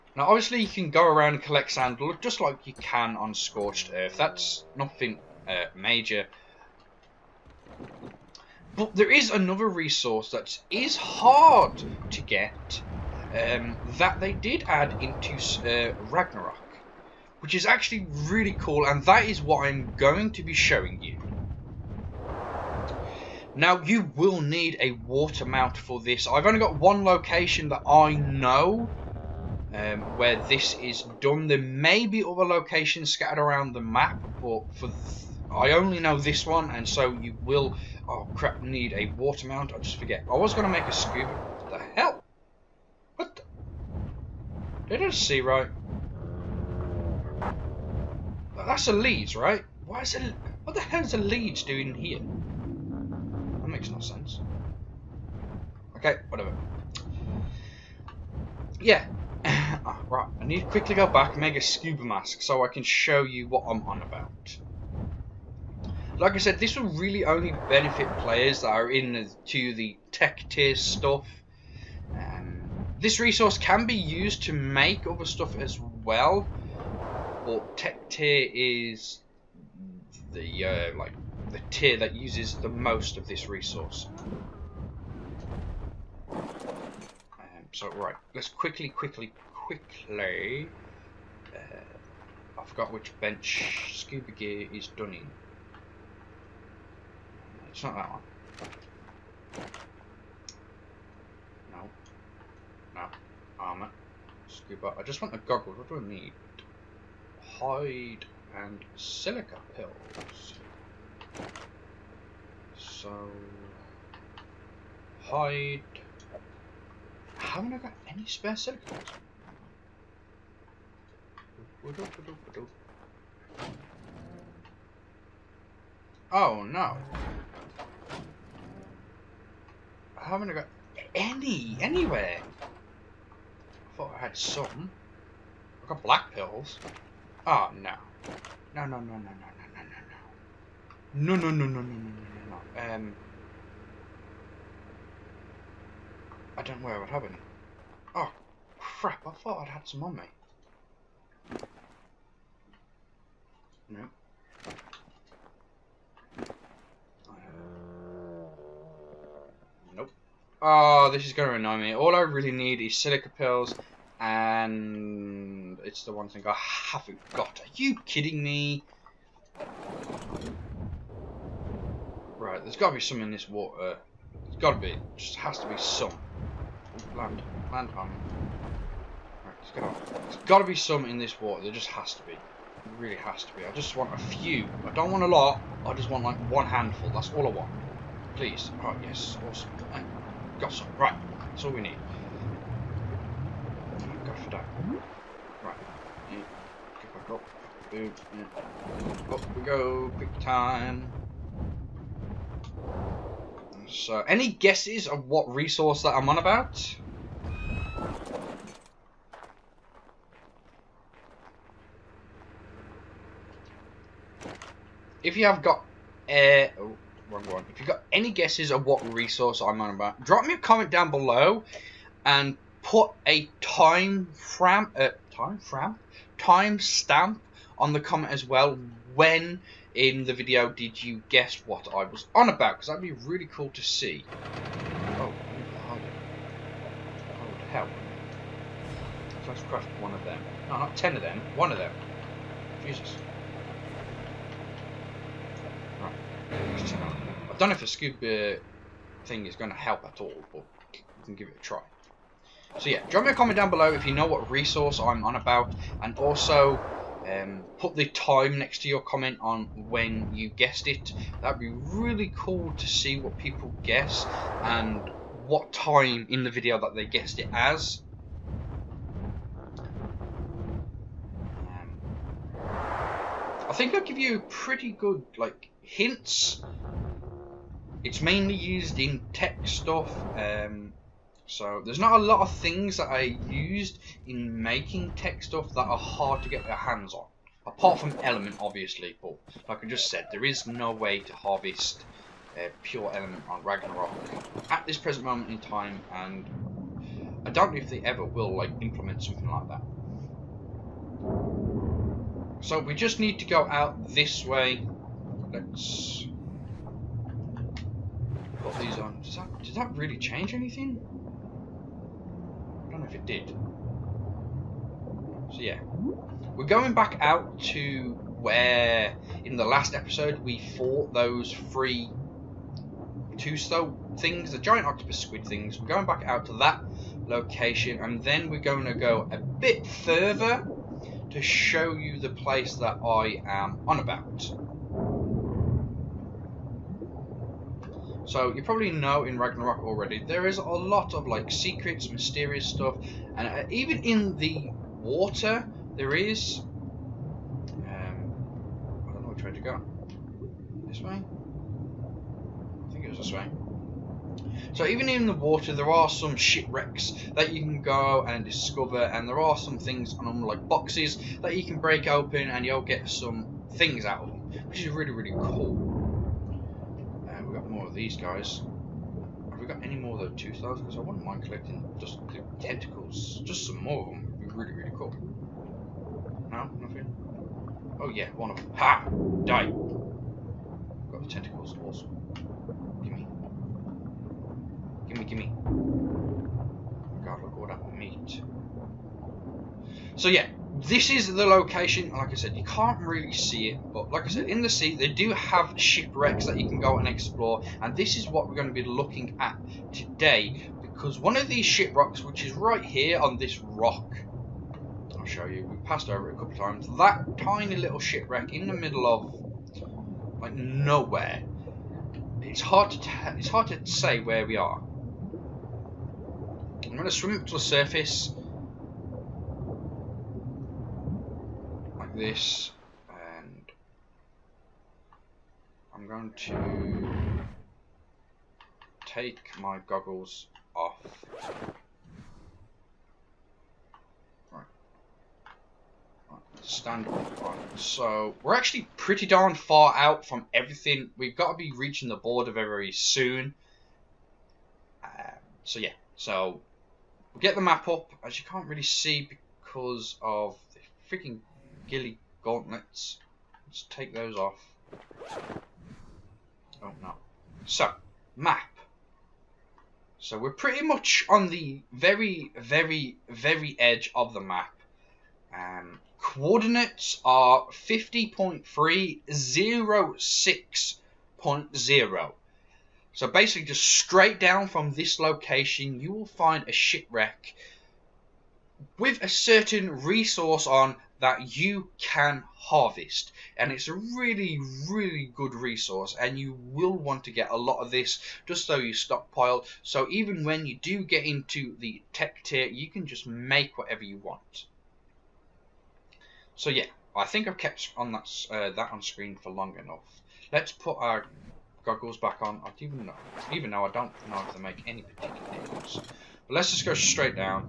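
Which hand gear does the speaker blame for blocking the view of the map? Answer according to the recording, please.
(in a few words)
Ghillie gauntlets.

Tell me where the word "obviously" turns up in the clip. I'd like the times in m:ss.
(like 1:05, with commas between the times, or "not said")
0:00, 4:48.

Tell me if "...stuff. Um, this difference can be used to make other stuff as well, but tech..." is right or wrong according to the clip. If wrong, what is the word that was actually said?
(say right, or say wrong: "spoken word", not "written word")
wrong: "resource", not "difference".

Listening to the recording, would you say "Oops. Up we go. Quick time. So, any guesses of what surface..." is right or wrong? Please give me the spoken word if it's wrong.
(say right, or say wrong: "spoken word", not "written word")
wrong: "resource", not "surface".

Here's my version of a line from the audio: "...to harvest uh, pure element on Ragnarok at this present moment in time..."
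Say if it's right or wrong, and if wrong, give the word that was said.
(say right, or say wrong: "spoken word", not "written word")
right.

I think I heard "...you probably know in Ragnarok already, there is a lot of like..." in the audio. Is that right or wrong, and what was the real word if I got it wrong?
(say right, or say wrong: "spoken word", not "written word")
right.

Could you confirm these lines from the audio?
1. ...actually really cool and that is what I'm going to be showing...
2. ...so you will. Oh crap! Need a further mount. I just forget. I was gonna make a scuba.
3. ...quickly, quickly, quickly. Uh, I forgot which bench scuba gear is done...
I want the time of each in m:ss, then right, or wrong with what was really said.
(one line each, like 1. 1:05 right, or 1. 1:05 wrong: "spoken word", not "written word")
1. 0:17 right
2. 0:36 wrong: "water", not "further"
3. 1:28 right.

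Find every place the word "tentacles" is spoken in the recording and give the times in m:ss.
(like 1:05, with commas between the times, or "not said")
6:12, 6:21.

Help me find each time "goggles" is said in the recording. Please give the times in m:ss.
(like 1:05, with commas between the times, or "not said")
1:45, 7:09, 8:21.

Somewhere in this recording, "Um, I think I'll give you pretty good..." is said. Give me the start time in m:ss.
4:31.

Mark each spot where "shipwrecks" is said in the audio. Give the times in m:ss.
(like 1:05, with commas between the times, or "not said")
5:56, 6:35, 6:41, 6:47, 7:56.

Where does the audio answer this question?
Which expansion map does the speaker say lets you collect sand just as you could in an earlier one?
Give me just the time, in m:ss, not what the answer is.
0:03.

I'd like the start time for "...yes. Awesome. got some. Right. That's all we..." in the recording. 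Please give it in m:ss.
3:09.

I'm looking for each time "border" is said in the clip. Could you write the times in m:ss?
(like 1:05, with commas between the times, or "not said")
7:22.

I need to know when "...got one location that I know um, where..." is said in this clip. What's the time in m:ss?
0:26.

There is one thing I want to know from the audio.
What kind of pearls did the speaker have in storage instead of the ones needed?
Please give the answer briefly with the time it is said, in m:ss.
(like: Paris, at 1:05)
black pearls, at 2:16.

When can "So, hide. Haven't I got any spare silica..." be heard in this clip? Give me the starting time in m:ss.
1:52.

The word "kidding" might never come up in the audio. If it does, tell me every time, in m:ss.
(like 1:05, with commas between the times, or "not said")
2:48.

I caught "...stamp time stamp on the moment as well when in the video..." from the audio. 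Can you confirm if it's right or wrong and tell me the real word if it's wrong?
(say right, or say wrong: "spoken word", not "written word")
wrong: "comment", not "moment".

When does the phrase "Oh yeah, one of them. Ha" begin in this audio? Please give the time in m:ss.
6:17.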